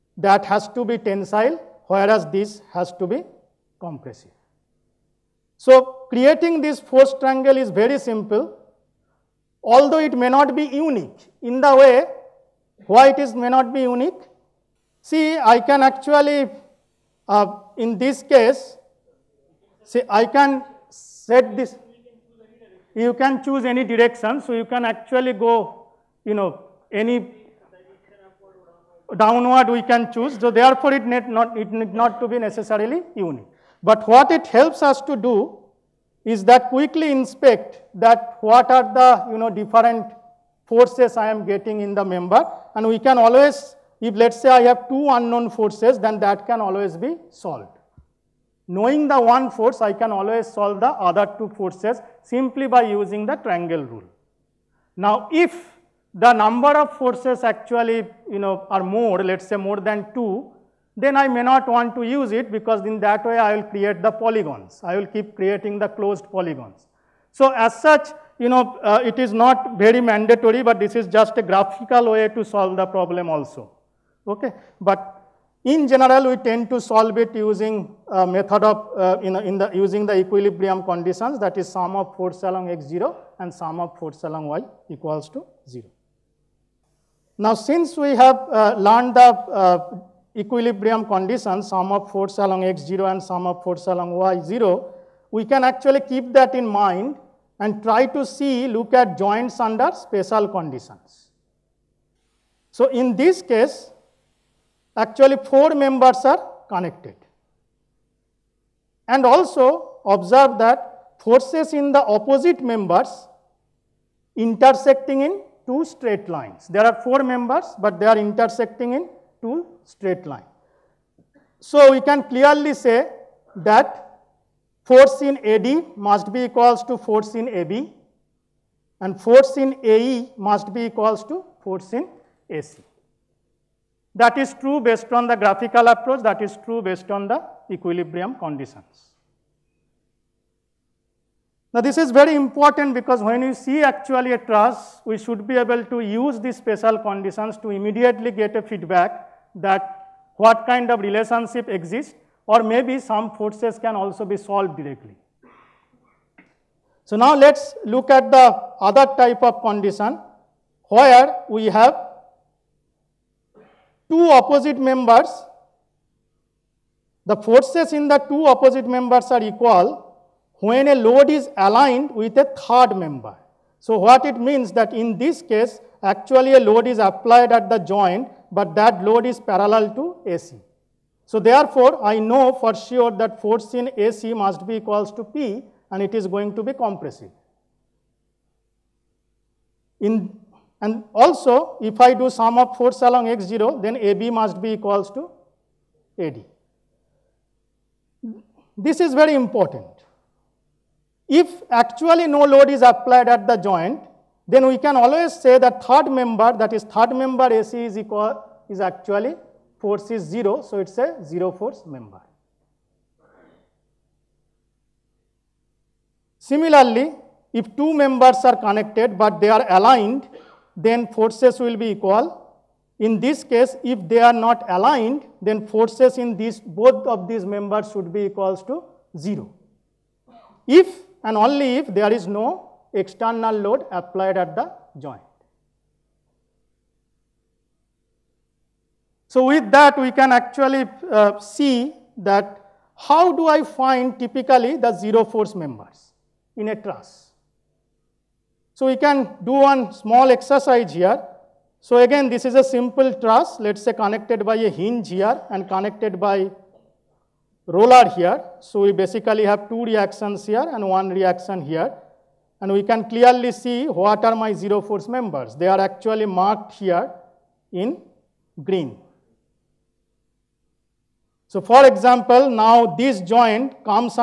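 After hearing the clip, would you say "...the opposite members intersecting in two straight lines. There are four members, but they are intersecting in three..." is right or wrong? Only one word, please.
wrong.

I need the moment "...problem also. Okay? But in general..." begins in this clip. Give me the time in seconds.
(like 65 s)
72 s.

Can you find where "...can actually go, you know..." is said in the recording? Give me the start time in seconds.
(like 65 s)
24 s.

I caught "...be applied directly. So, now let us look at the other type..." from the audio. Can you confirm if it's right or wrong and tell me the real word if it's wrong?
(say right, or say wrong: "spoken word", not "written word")
wrong: "solved", not "applied".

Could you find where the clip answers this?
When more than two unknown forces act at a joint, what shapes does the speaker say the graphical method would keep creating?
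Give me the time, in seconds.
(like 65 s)
65 s.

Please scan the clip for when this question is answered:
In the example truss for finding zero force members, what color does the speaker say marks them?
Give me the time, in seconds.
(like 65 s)
268 s.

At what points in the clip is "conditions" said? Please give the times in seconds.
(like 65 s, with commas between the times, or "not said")
80 s, 91 s, 100 s, 138 s, 146 s, 159 s.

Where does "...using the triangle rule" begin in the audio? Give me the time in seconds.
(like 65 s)
52 s.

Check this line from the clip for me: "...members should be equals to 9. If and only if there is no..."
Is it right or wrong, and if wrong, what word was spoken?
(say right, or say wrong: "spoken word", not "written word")
wrong: "0", not "9".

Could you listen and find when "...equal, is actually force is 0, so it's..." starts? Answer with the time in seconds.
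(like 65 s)
207 s.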